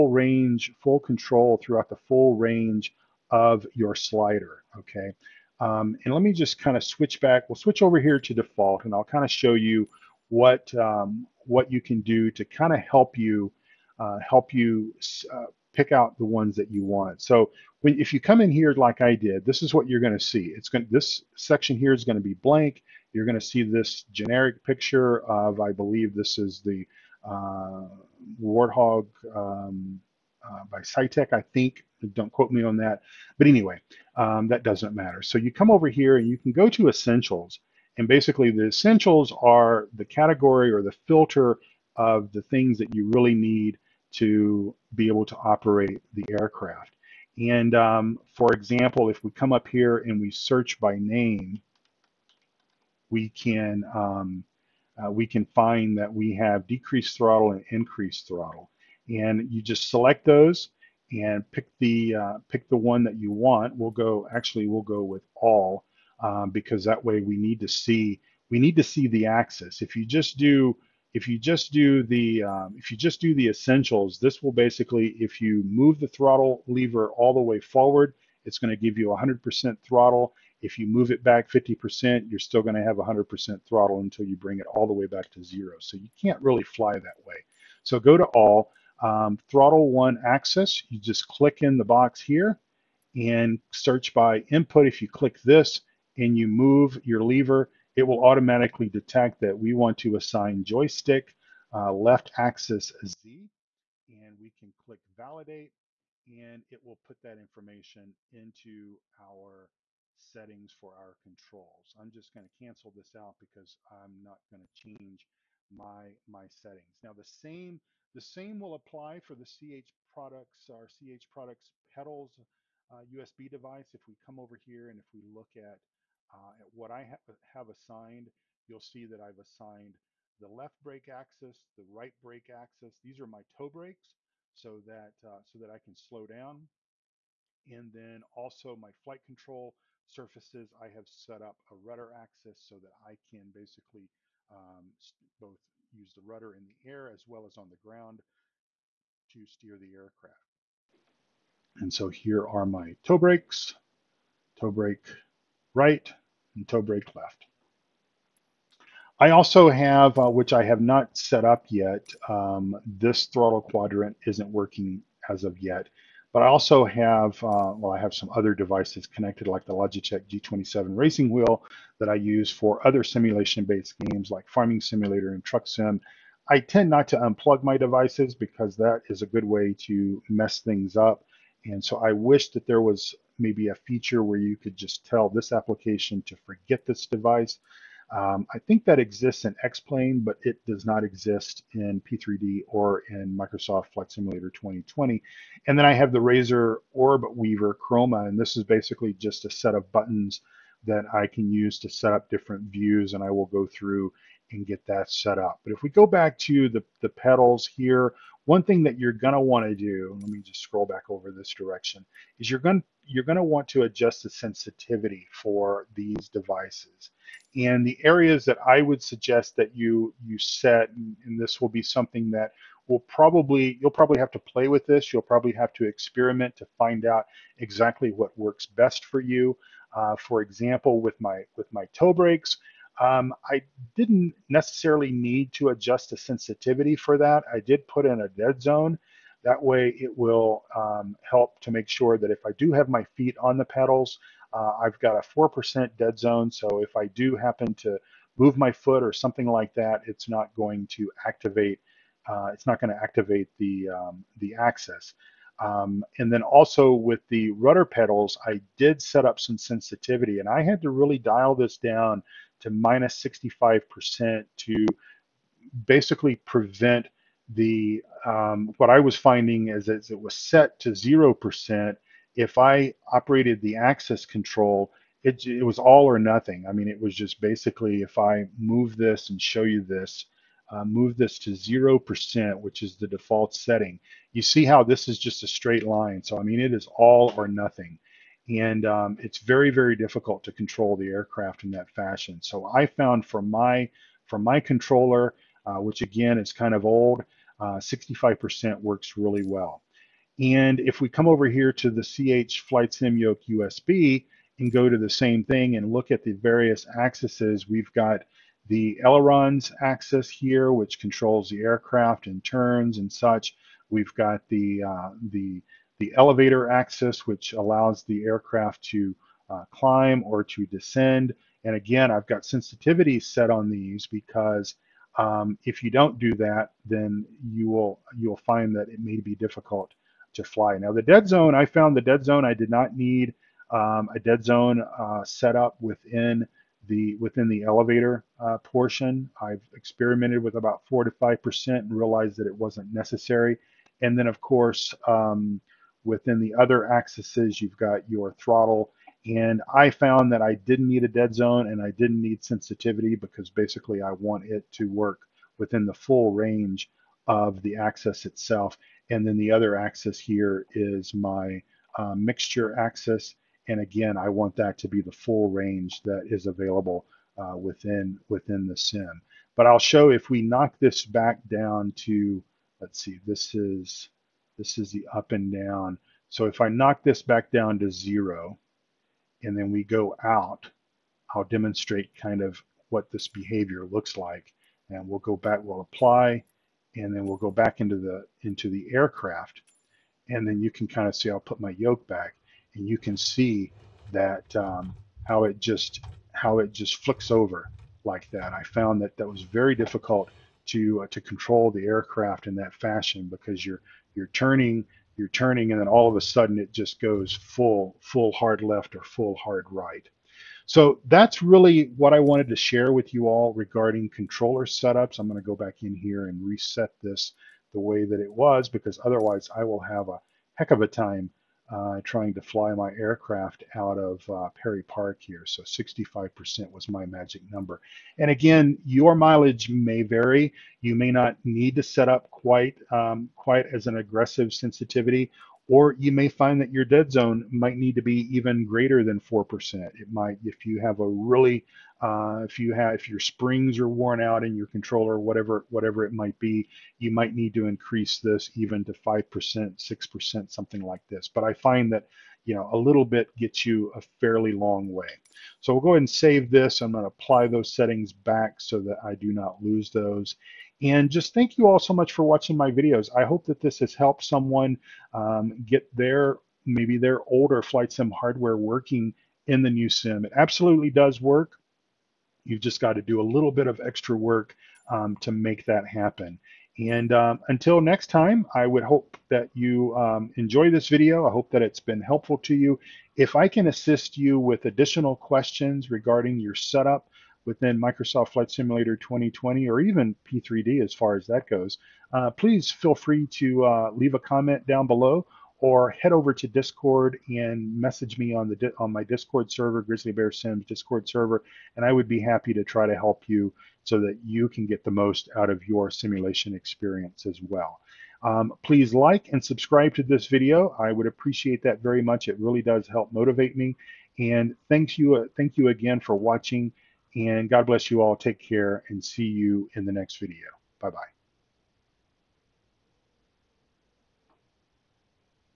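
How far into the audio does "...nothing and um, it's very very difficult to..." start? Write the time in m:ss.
4:47.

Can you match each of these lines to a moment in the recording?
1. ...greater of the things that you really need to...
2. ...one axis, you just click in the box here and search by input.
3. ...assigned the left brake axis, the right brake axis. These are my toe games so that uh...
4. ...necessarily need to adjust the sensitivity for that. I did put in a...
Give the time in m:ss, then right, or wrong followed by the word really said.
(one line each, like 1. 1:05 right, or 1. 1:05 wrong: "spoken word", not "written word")
1. 0:41 wrong: "filter", not "greater"
2. 1:29 right
3. 2:09 wrong: "brakes", not "games"
4. 3:54 right.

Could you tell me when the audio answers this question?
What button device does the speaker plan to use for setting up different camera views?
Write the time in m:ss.
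3:16.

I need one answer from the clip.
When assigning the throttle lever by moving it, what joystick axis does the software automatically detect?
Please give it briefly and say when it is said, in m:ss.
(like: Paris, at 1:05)
left axis Z, at 1:41.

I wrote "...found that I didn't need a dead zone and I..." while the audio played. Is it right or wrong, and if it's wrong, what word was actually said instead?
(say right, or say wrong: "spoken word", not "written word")
right.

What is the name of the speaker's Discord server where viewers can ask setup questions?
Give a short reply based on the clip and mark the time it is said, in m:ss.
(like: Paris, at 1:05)
Grizzly Bear Sims, at 8:19.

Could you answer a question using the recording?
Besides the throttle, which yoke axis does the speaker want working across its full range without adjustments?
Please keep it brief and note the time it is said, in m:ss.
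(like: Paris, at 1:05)
mixture, at 6:02.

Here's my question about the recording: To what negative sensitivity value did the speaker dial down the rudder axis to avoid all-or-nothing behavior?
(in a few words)
-65%.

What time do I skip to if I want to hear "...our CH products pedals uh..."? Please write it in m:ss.
2:00.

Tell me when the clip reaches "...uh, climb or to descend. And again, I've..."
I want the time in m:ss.
5:19.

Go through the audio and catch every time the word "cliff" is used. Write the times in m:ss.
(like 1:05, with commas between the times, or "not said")
not said.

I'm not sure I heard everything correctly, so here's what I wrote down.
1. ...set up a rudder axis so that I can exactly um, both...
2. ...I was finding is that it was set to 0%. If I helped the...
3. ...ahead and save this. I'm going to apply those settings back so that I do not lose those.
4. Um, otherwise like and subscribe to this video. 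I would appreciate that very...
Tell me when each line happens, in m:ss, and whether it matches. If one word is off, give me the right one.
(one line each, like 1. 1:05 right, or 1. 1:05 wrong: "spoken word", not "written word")
1. 2:21 wrong: "basically", not "exactly"
2. 4:28 wrong: "operated", not "helped"
3. 7:35 right
4. 8:28 wrong: "please", not "otherwise".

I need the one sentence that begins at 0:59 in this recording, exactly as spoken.
And you just select those and pick the uh, pick the one that you want.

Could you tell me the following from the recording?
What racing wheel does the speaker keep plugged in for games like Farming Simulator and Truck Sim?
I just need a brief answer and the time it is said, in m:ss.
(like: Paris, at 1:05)
Logitech G27, at 2:49.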